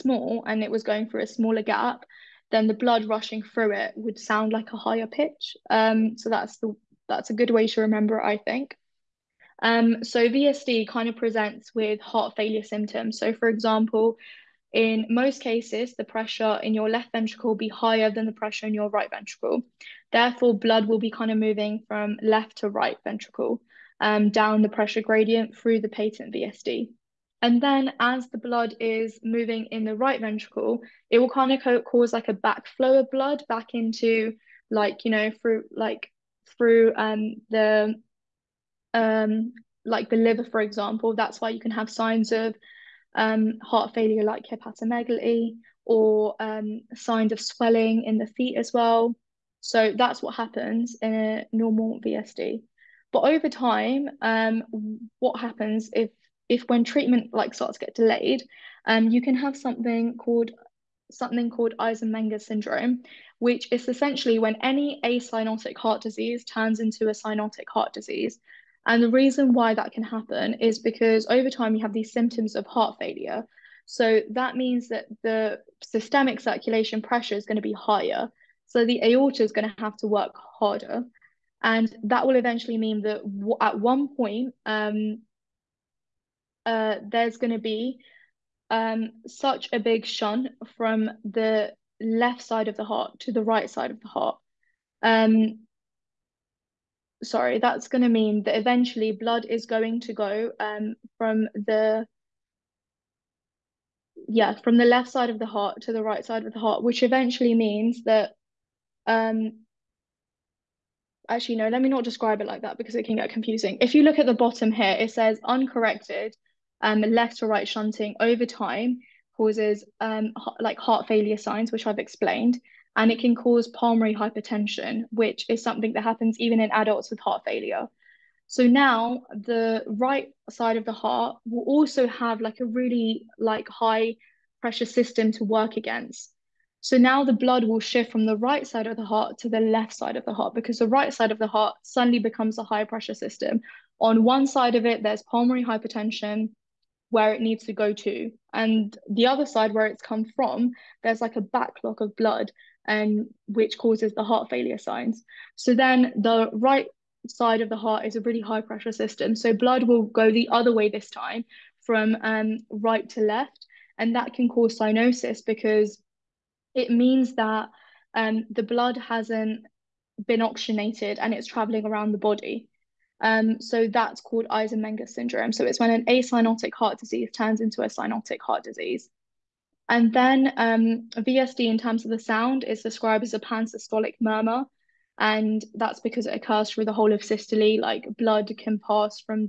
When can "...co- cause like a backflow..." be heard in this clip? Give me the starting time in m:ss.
0:31.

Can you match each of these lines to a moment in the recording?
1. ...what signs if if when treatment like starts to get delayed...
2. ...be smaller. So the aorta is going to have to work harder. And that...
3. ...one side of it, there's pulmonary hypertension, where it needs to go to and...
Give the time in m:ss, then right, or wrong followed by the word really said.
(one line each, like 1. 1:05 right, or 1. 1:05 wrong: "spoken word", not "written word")
1. 0:55 wrong: "happens", not "signs"
2. 1:17 wrong: "higher", not "smaller"
3. 2:24 right.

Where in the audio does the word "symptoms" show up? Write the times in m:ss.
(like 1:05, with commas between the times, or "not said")
0:12, 1:12.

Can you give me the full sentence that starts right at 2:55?
So it's when an acyanotic heart disease turns into a cyanotic heart disease.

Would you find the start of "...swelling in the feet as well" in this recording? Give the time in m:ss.
0:47.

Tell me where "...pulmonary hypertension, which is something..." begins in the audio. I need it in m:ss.
2:03.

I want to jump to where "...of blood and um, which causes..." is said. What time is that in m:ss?
2:32.